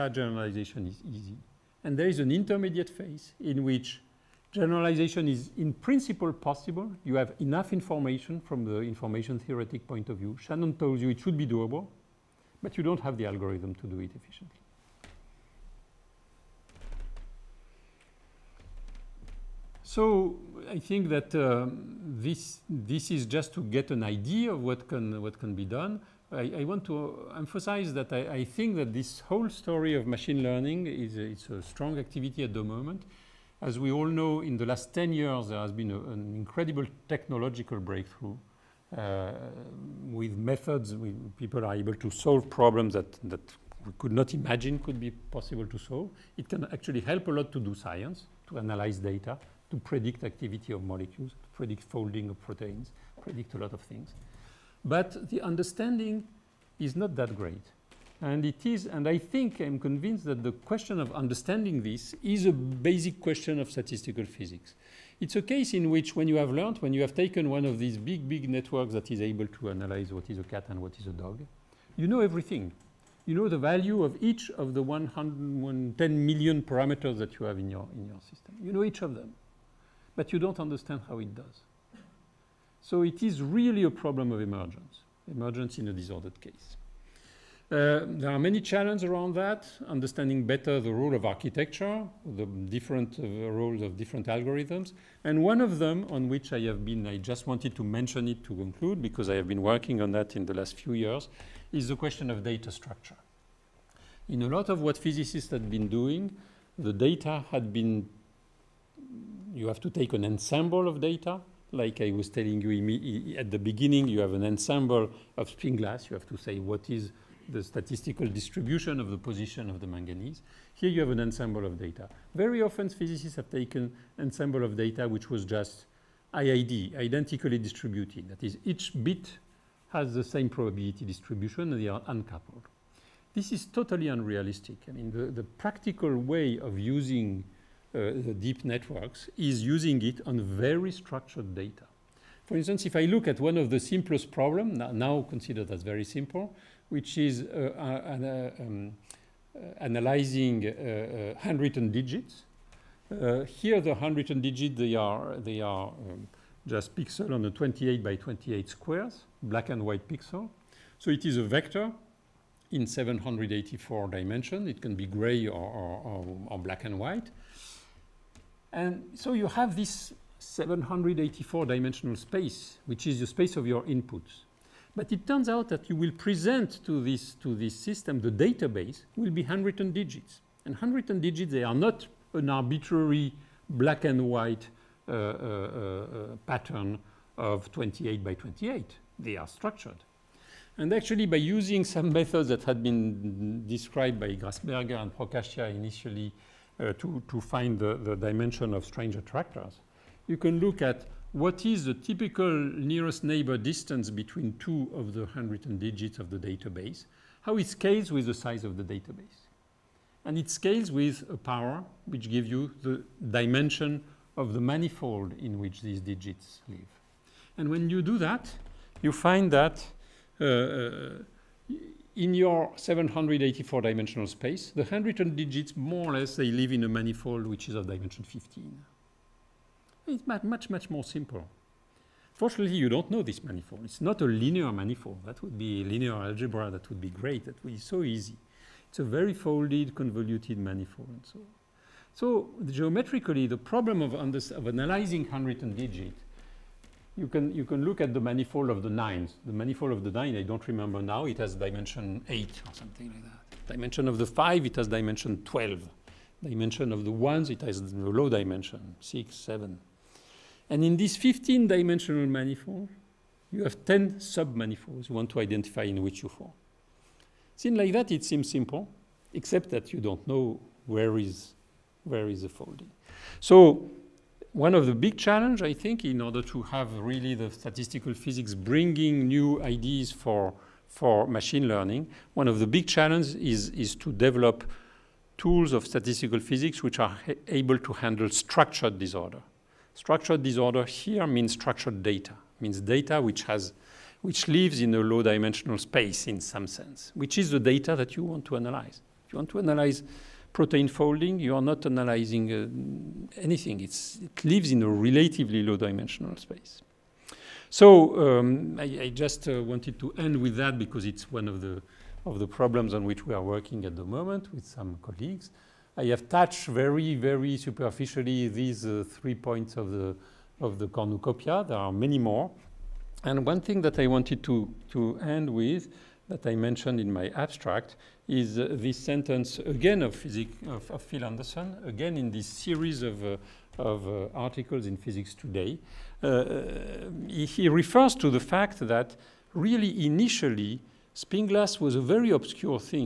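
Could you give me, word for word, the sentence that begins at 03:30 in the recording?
And it scales with a power which gives you the dimension of the manifold in which these digits live.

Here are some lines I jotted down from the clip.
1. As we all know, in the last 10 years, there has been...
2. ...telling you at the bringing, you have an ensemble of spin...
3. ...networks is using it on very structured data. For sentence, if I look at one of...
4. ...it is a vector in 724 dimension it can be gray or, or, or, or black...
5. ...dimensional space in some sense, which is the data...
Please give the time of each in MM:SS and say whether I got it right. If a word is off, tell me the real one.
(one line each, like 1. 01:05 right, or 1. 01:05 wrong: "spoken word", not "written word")
1. 00:33 right
2. 01:52 wrong: "beginning", not "bringing"
3. 02:18 wrong: "instance", not "sentence"
4. 02:41 wrong: "784", not "724"
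5. 04:55 right.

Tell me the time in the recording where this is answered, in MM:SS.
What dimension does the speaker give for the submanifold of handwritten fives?
04:15.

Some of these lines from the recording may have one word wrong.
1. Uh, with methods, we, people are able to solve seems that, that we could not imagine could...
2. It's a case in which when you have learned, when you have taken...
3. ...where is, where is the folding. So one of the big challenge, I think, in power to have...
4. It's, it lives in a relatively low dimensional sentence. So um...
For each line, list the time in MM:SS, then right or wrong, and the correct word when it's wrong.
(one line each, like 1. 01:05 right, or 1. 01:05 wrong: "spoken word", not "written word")
1. 00:38 wrong: "problems", not "seems"
2. 01:05 right
3. 04:30 wrong: "order", not "power"
4. 05:03 wrong: "space", not "sentence".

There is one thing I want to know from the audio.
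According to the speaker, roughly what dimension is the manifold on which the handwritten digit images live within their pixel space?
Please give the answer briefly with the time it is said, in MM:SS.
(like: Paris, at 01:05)
15, at 03:48.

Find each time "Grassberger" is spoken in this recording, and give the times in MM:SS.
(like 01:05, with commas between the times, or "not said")
03:14.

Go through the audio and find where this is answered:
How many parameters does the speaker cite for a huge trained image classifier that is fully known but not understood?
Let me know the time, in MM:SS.
01:14.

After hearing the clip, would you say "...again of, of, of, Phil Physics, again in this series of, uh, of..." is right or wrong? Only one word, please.
wrong.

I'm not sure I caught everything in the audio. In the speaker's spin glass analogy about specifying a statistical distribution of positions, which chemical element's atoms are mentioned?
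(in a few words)
Manganese.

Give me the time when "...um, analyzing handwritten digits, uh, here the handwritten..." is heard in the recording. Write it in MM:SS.
02:28.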